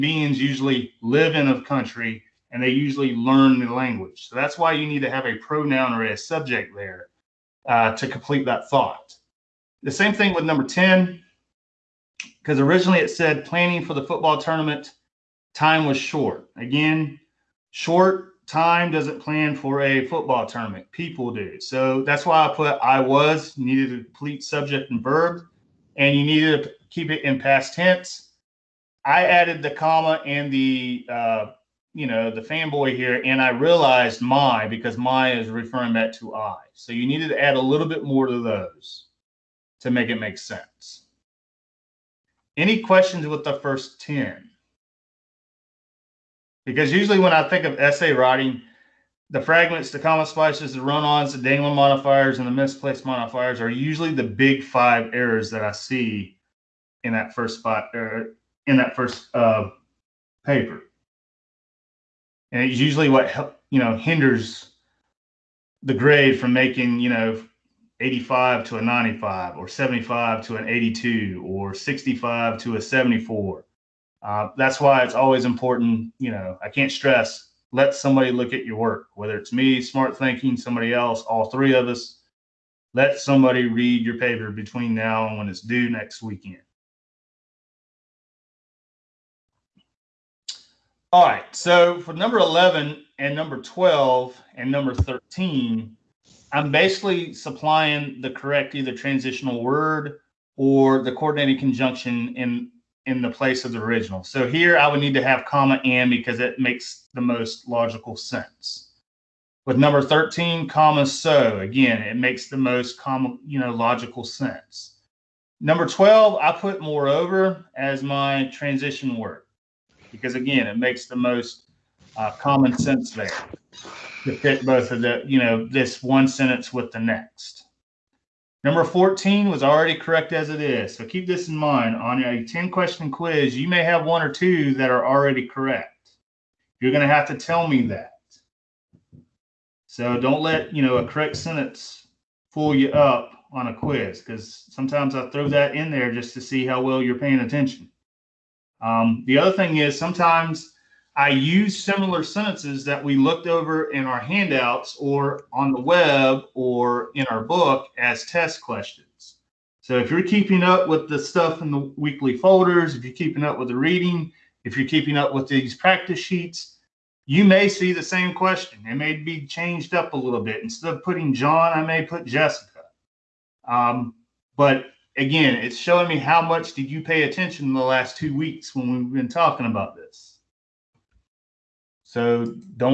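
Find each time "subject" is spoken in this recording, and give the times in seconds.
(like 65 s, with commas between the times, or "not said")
6 s, 24 s.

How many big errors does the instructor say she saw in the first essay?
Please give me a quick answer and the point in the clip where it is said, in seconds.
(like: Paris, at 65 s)
five, at 54 s.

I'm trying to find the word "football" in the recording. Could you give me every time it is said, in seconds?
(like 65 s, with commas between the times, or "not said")
14 s, 20 s.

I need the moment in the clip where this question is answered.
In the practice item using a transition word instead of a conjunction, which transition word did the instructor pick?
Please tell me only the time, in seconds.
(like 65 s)
116 s.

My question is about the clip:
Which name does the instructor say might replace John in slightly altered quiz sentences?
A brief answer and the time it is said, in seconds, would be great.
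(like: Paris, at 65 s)
Jessica, at 172 s.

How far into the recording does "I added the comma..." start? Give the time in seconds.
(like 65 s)
29 s.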